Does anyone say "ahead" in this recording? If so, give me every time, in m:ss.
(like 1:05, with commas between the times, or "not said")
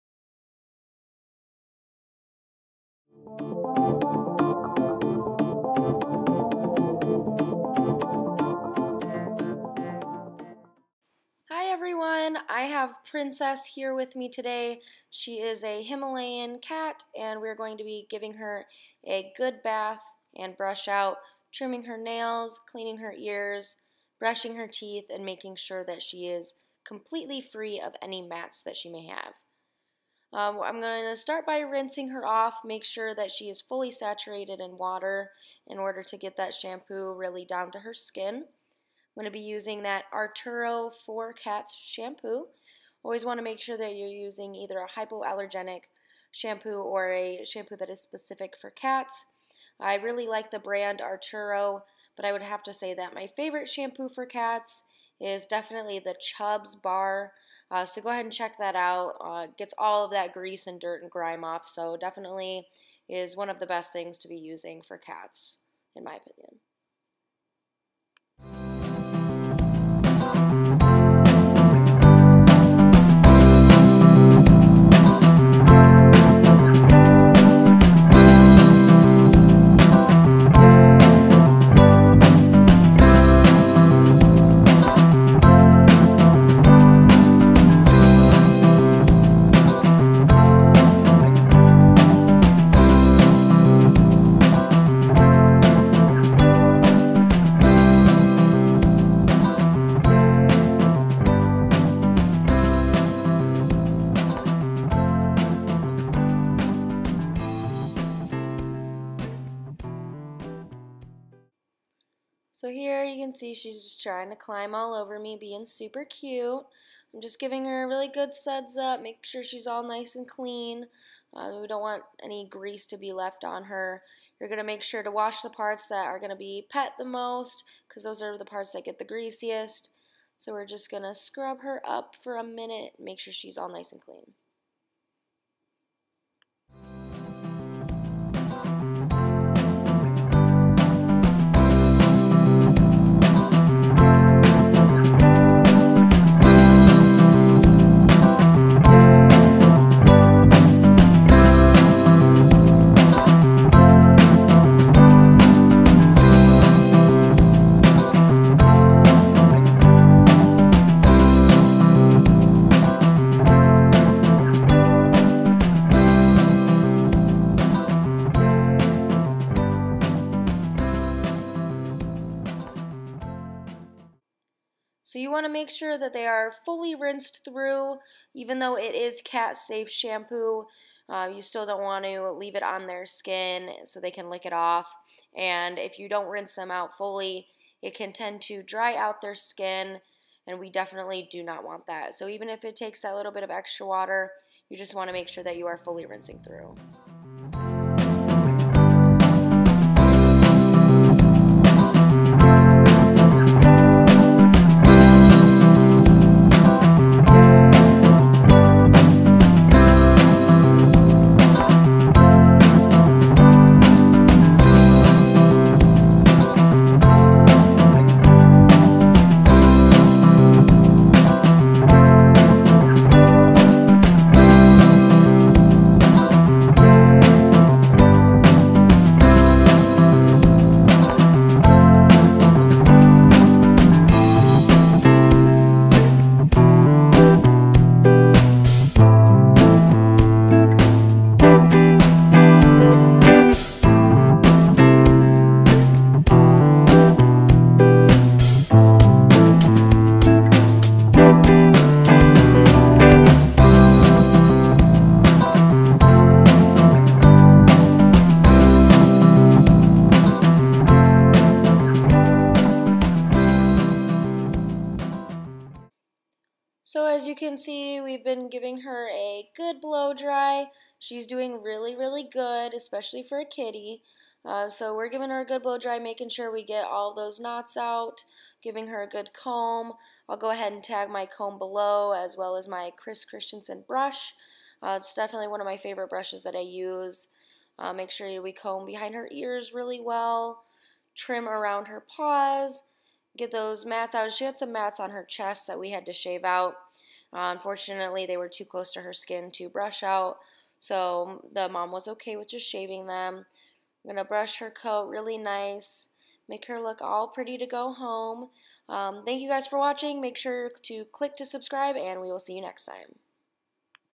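0:58, 4:40.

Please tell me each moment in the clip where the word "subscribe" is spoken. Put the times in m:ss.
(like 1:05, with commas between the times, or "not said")
5:11.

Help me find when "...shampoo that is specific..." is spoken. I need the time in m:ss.
0:47.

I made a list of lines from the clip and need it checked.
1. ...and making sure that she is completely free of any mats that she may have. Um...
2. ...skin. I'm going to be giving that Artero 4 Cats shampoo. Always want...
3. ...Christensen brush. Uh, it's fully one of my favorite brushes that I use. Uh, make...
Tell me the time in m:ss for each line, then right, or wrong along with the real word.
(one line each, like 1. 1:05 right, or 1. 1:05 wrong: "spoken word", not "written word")
1. 0:25 right
2. 0:37 wrong: "using", not "giving"
3. 4:43 wrong: "definitely", not "fully".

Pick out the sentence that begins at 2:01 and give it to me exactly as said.
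Uh, we don't want any grease to be left on her.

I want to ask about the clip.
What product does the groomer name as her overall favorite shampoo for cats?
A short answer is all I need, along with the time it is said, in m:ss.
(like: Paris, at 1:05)
Chubbs Bar, at 0:56.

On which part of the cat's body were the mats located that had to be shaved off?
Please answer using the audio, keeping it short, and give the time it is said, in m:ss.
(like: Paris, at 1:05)
Chest, at 4:55.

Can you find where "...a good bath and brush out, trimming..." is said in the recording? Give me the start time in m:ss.
0:19.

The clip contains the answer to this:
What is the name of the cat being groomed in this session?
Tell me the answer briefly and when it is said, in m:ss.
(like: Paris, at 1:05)
Princess, at 0:13.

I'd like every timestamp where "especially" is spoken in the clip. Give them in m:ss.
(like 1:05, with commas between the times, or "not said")
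4:32.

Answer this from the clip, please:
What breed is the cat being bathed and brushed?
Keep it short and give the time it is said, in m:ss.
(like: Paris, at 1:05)
Himalayan, at 0:15.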